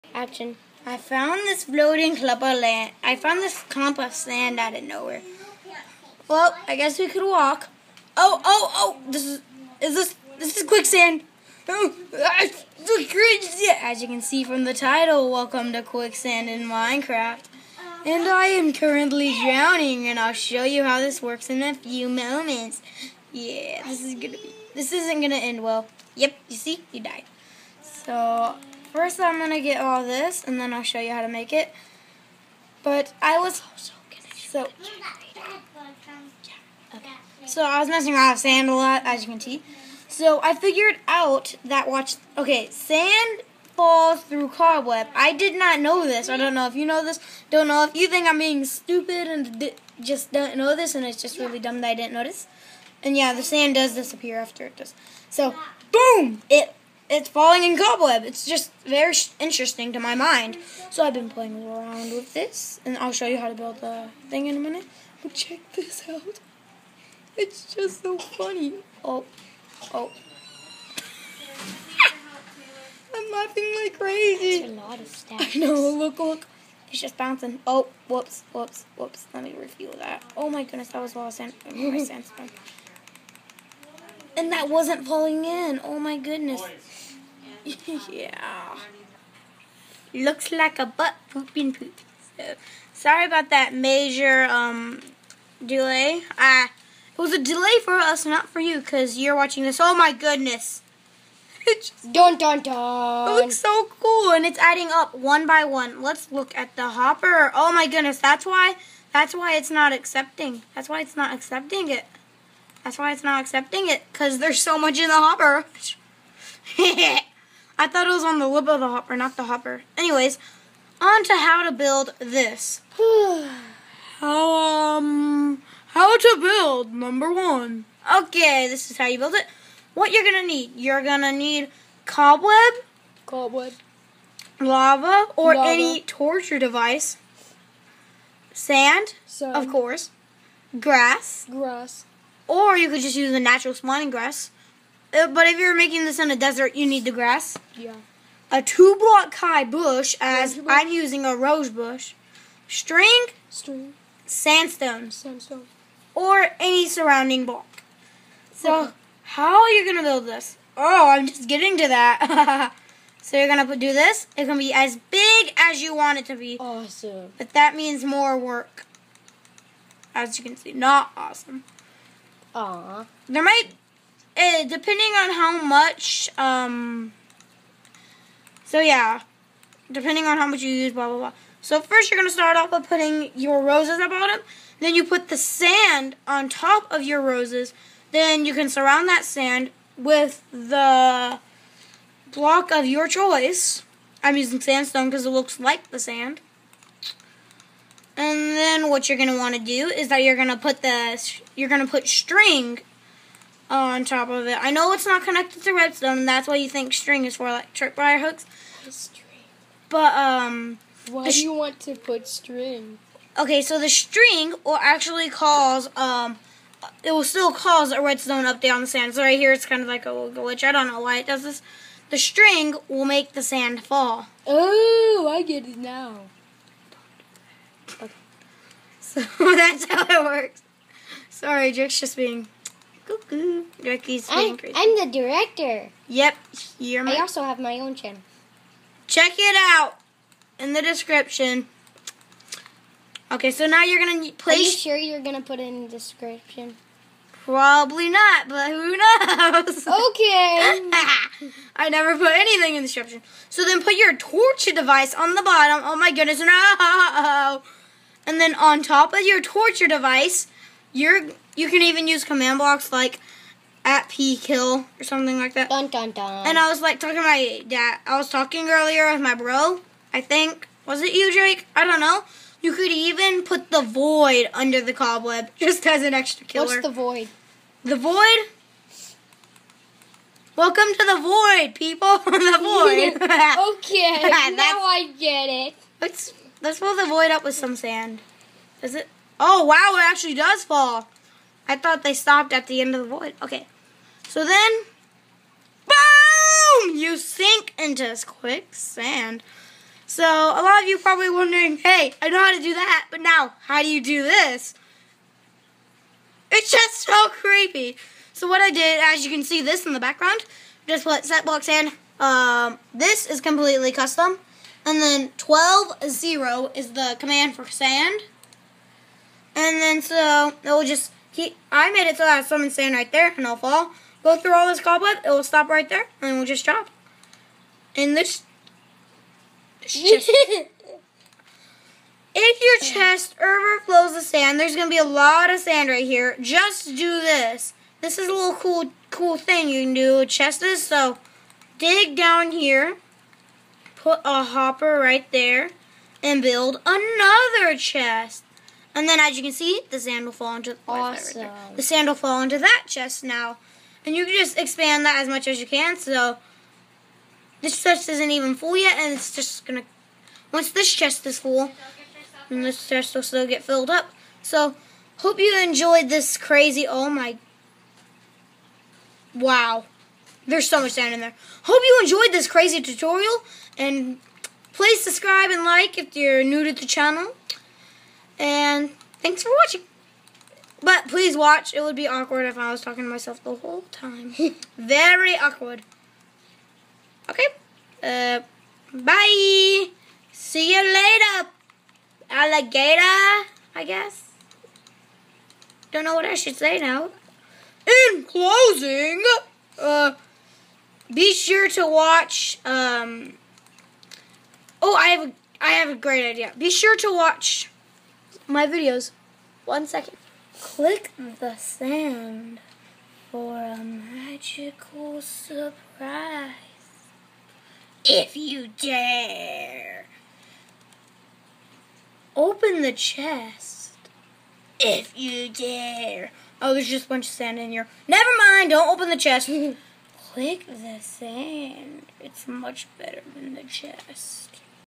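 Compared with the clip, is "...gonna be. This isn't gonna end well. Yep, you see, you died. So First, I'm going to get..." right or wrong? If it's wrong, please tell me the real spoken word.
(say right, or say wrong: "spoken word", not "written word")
right.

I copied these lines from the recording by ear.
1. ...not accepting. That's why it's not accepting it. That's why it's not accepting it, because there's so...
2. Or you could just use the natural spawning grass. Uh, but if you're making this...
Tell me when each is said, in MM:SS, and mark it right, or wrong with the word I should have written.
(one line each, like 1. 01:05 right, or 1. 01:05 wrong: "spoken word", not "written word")
1. 01:49 right
2. 02:22 right.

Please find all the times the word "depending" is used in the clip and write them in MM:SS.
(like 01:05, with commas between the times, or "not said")
02:54, 02:59.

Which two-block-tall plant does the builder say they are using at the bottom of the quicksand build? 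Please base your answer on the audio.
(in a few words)
Rose bush.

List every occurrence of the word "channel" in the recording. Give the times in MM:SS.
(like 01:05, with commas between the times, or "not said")
03:57, 06:16.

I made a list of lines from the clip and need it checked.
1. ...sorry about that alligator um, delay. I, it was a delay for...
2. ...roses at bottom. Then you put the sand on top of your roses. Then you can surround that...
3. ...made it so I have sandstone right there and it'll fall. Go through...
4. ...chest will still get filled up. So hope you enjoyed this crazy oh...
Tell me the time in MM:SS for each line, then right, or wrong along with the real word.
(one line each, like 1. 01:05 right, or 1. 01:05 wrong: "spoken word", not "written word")
1. 01:32 wrong: "major", not "alligator"
2. 03:03 right
3. 05:21 wrong: "someone", not "sandstone"
4. 06:02 right.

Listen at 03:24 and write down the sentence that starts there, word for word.
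I know it's not connected to redstone, and that's why you think string is for, like tripwire hooks.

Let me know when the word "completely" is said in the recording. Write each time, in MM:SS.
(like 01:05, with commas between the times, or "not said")
05:13.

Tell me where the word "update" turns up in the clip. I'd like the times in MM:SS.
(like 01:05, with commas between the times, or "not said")
03:38.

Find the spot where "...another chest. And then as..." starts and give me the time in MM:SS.
05:46.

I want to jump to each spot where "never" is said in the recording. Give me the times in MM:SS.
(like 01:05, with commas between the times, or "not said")
04:11, 07:08.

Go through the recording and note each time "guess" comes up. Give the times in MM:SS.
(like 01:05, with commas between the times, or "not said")
00:06, 06:33.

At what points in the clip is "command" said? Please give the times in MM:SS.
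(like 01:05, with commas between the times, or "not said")
04:22, 05:17.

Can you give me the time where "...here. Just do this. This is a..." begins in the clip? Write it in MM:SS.
05:36.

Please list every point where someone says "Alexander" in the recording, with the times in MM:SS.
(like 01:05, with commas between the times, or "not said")
not said.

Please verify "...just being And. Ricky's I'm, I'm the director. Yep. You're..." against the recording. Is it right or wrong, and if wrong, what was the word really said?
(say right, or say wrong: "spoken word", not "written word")
wrong: "Cuckoo", not "And".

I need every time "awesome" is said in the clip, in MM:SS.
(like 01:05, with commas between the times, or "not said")
02:46, 02:51, 05:50.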